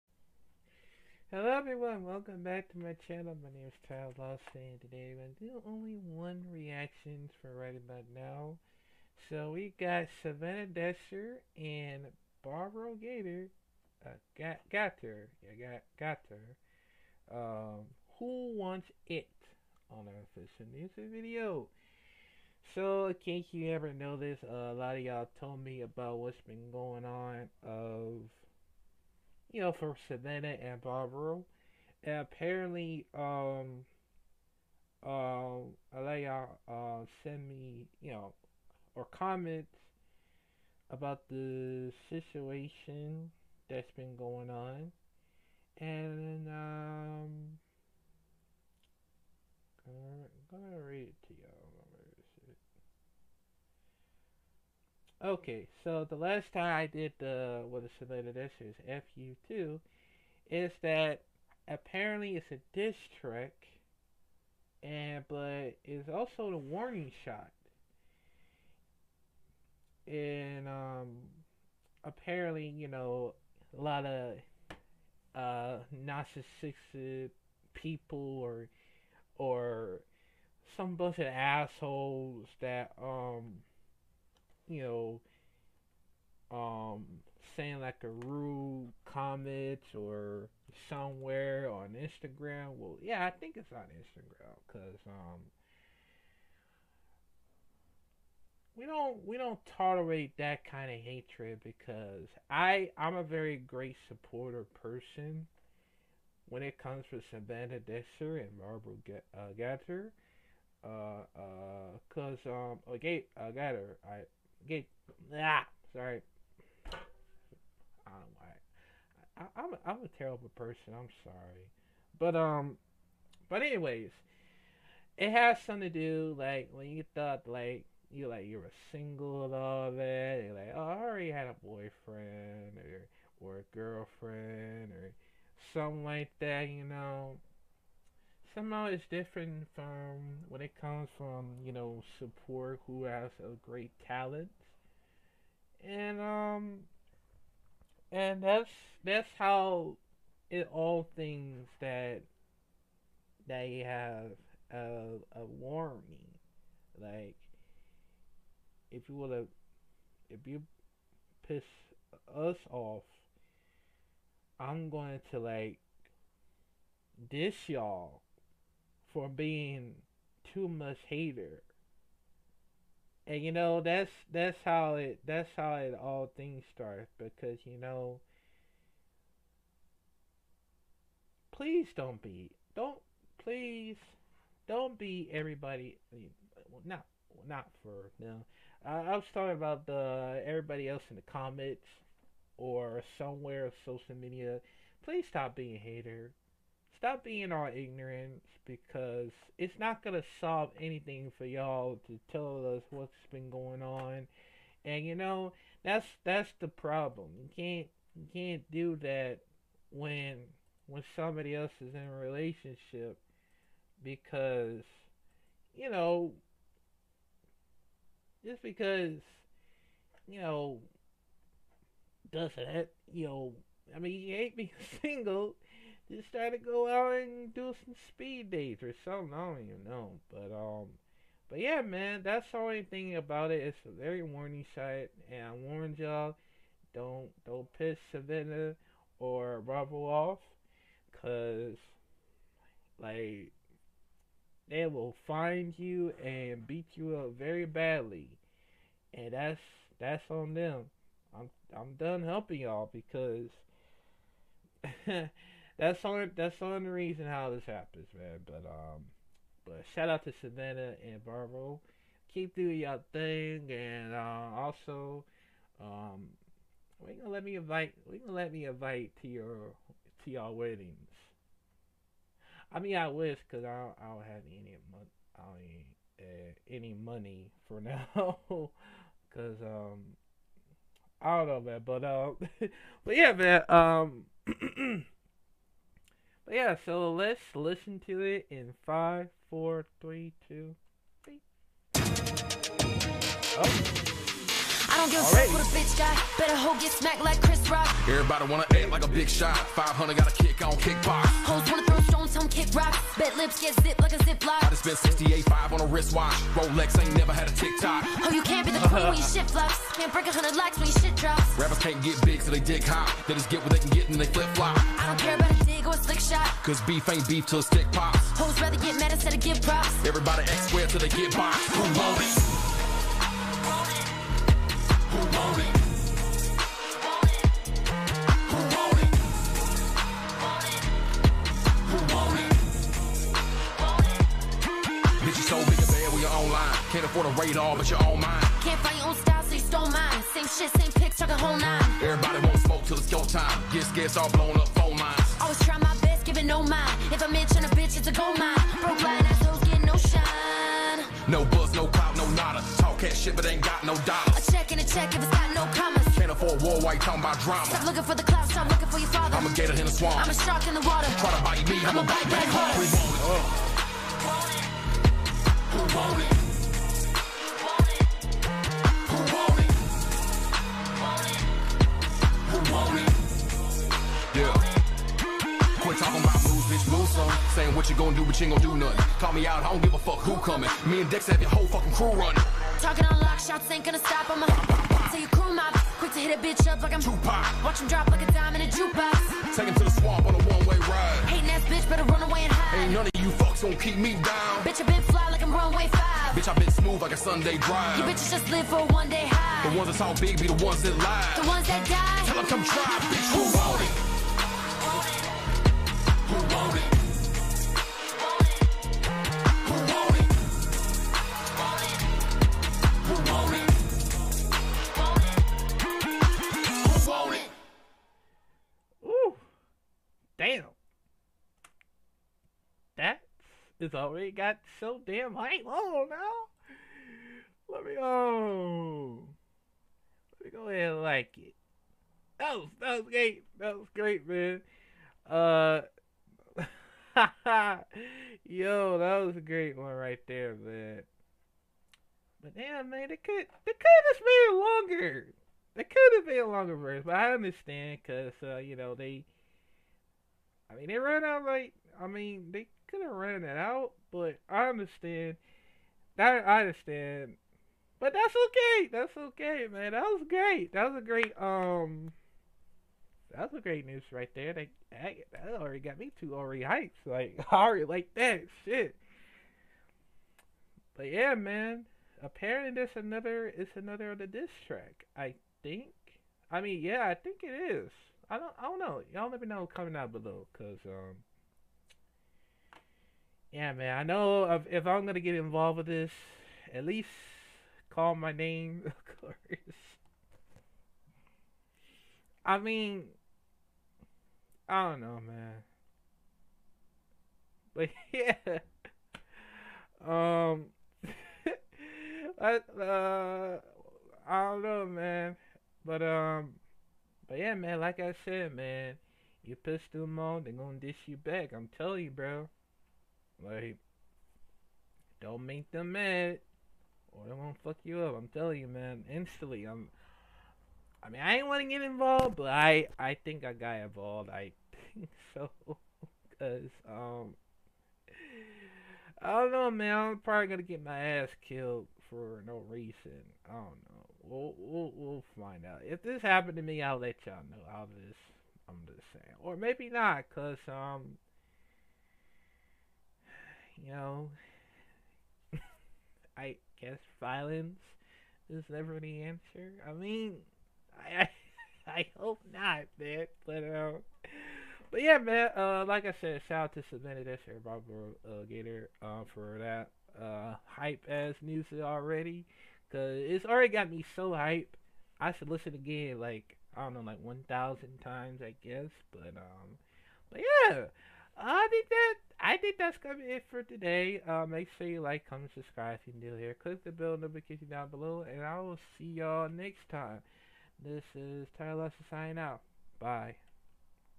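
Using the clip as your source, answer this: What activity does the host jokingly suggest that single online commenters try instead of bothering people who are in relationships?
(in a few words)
speed dates.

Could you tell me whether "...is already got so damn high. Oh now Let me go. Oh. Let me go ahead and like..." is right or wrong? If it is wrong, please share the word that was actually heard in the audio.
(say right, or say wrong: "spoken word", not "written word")
right.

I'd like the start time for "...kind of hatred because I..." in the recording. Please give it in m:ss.
1:40.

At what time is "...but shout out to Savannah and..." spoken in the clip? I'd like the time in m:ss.
4:19.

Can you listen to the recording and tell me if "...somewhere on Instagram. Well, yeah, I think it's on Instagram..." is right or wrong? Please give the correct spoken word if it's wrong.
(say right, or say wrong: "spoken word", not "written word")
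right.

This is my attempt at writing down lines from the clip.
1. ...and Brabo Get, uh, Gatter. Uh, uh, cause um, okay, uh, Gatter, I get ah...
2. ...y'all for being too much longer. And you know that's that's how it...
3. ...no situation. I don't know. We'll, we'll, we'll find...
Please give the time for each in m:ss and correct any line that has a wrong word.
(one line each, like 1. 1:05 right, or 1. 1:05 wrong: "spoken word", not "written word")
1. 1:48 right
2. 2:47 wrong: "hater", not "longer"
3. 8:52 wrong: "reason", not "situation".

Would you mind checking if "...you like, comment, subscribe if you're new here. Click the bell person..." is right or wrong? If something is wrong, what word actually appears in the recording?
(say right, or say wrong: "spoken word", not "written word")
wrong: "notification", not "person".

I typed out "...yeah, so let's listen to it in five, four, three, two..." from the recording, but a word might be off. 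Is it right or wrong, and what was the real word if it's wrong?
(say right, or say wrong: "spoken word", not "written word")
right.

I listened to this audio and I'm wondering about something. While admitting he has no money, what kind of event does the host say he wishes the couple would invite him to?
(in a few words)
weddings.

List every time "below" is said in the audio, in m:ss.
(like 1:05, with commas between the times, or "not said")
8:00, 9:37.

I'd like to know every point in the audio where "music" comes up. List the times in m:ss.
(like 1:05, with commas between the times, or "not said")
0:20, 9:21.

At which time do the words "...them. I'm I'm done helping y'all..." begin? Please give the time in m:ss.
4:10.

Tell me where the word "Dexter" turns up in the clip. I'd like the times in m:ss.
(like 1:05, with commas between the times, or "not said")
0:10, 1:47.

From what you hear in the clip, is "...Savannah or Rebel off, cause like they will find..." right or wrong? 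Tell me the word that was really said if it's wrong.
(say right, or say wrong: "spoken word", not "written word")
right.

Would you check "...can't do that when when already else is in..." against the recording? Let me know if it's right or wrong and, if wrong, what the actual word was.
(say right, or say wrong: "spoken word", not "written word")
wrong: "somebody", not "already".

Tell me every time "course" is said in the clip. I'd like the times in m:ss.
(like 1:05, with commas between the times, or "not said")
8:09.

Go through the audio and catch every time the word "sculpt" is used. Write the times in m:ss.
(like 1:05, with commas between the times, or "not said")
not said.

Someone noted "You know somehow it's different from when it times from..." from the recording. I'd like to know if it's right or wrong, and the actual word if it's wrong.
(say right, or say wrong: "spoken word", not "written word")
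wrong: "comes", not "times".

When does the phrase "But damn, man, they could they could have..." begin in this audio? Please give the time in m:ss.
7:22.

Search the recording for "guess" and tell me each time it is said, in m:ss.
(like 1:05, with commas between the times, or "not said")
9:06, 9:28.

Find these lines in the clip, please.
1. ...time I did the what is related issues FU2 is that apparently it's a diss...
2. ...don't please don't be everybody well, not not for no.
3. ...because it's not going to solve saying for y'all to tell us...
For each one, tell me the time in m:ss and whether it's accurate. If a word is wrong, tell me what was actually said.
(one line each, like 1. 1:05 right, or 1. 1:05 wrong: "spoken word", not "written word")
1. 0:56 right
2. 3:02 right
3. 3:18 wrong: "anything", not "saying".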